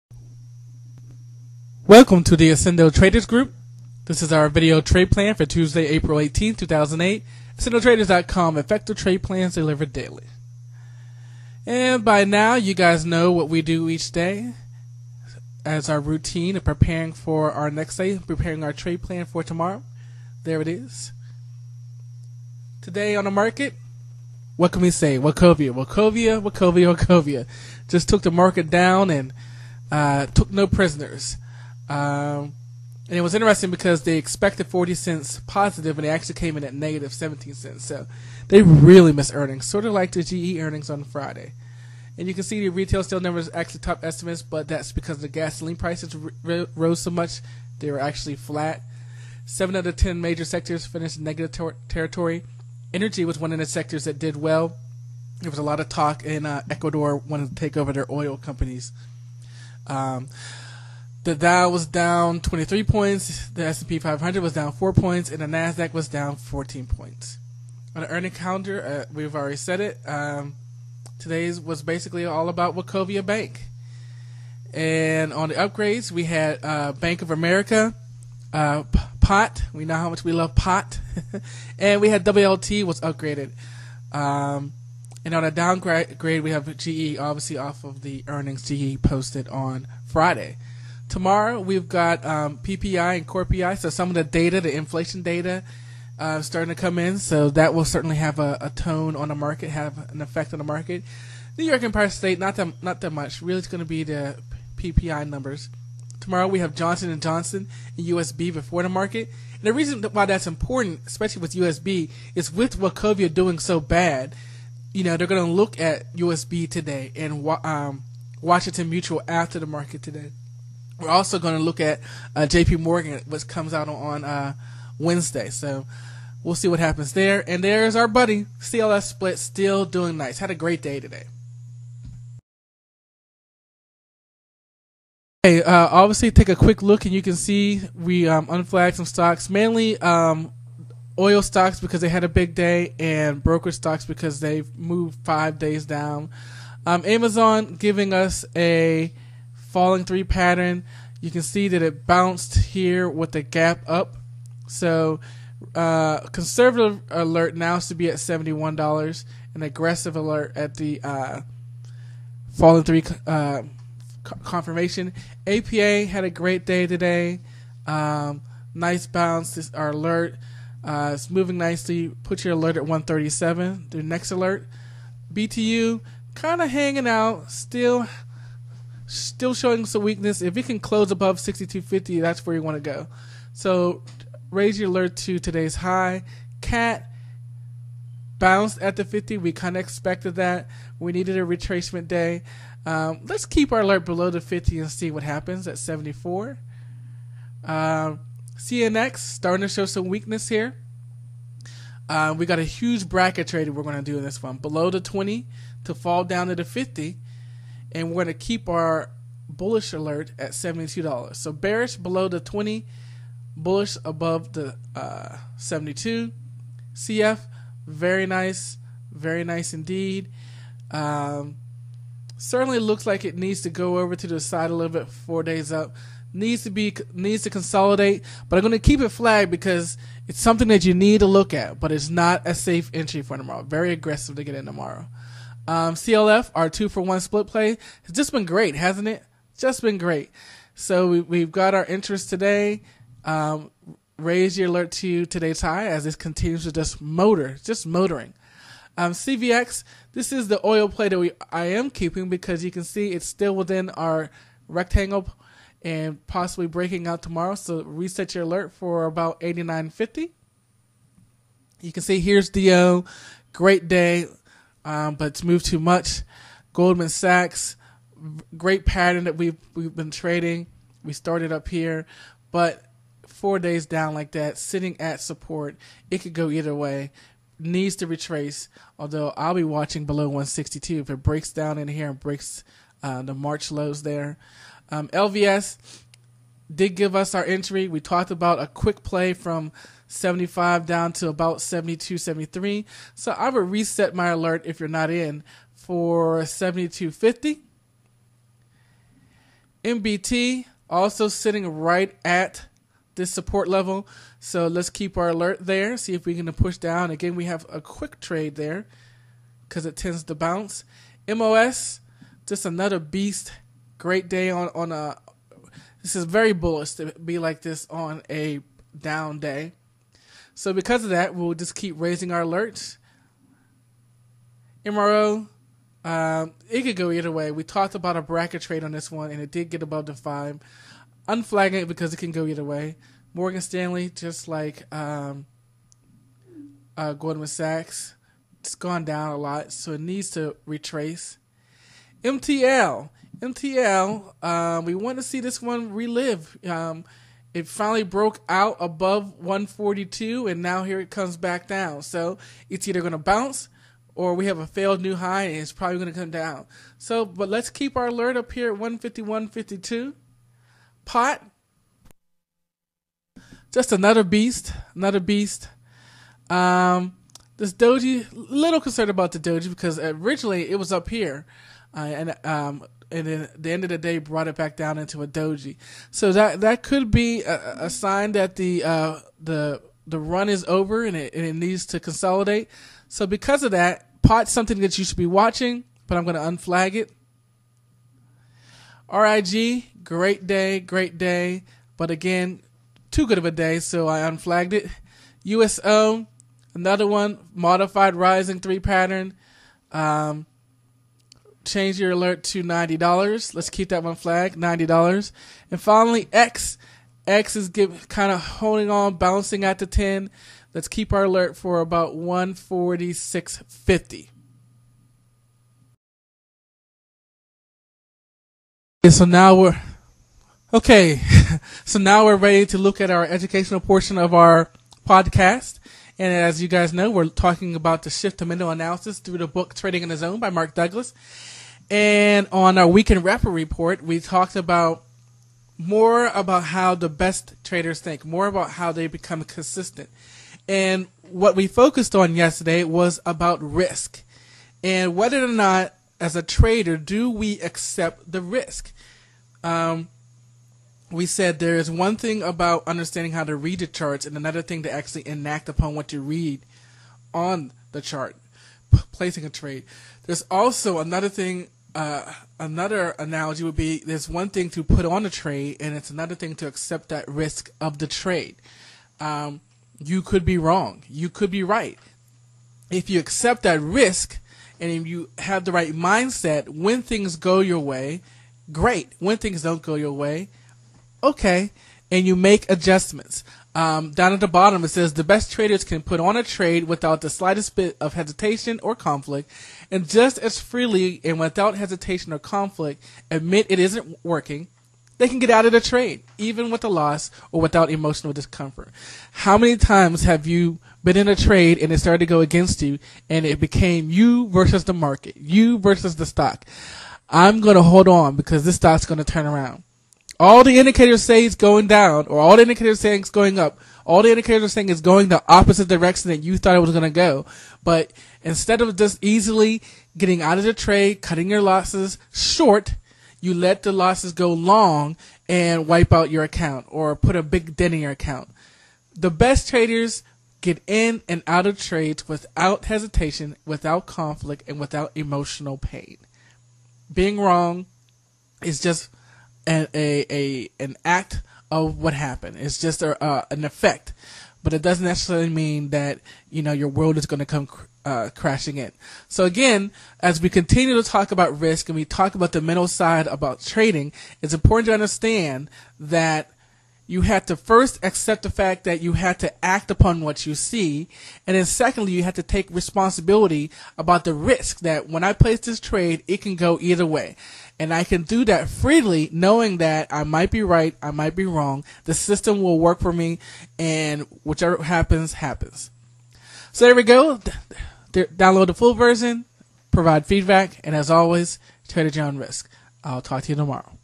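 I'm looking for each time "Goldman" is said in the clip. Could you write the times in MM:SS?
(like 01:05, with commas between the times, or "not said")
04:26, 05:37.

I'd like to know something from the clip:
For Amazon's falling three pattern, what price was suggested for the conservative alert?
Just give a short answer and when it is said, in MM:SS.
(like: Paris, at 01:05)
$71, at 02:38.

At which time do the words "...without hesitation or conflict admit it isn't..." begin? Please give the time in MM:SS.
08:11.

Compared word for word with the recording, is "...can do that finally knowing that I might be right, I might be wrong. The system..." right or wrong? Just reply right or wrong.
wrong.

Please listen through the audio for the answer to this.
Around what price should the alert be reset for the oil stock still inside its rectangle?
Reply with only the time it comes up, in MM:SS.
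04:19.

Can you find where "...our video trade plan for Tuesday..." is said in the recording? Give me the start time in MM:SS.
00:04.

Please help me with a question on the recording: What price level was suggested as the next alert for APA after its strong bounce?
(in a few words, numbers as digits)
137.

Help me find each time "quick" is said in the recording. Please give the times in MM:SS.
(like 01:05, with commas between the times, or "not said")
02:16, 04:48, 05:07.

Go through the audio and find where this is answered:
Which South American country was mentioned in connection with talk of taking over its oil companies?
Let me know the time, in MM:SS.
00:56.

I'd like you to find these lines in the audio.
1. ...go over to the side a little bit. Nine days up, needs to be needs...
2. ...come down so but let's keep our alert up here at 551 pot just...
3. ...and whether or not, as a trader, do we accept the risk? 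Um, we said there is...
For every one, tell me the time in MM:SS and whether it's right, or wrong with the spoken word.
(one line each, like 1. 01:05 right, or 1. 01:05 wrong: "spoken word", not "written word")
1. 03:43 wrong: "Four", not "Nine"
2. 05:56 wrong: "151", not "551"
3. 07:24 right.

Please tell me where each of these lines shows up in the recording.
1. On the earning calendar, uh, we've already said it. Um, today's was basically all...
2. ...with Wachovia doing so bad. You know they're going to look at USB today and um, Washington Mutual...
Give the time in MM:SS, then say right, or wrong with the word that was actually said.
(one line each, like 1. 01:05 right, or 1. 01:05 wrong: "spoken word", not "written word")
1. 01:07 right
2. 01:52 right.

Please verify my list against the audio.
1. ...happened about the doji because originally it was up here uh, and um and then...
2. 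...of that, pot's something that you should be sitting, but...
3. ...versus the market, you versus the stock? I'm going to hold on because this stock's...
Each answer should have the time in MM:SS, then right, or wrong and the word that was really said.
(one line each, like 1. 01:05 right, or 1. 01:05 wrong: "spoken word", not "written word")
1. 06:08 wrong: "concerned", not "happened"
2. 06:23 wrong: "watching", not "sitting"
3. 08:24 right.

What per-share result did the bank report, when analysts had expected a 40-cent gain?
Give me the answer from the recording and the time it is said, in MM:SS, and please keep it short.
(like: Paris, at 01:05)
negative 17 cents, at 00:36.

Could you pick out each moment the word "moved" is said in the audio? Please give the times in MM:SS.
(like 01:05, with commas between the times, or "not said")
02:24, 04:25.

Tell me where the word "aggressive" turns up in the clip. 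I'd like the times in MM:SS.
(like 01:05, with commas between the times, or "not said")
02:39, 03:53.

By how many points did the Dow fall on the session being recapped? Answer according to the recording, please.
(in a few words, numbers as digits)
23.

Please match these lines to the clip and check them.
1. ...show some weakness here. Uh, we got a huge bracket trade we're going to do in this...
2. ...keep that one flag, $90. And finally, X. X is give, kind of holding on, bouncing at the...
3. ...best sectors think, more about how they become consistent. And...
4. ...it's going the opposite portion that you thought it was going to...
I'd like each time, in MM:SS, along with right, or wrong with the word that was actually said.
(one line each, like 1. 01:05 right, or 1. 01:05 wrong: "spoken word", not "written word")
1. 03:19 right
2. 06:43 right
3. 07:17 wrong: "traders", not "sectors"
4. 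08:34 wrong: "direction", not "portion".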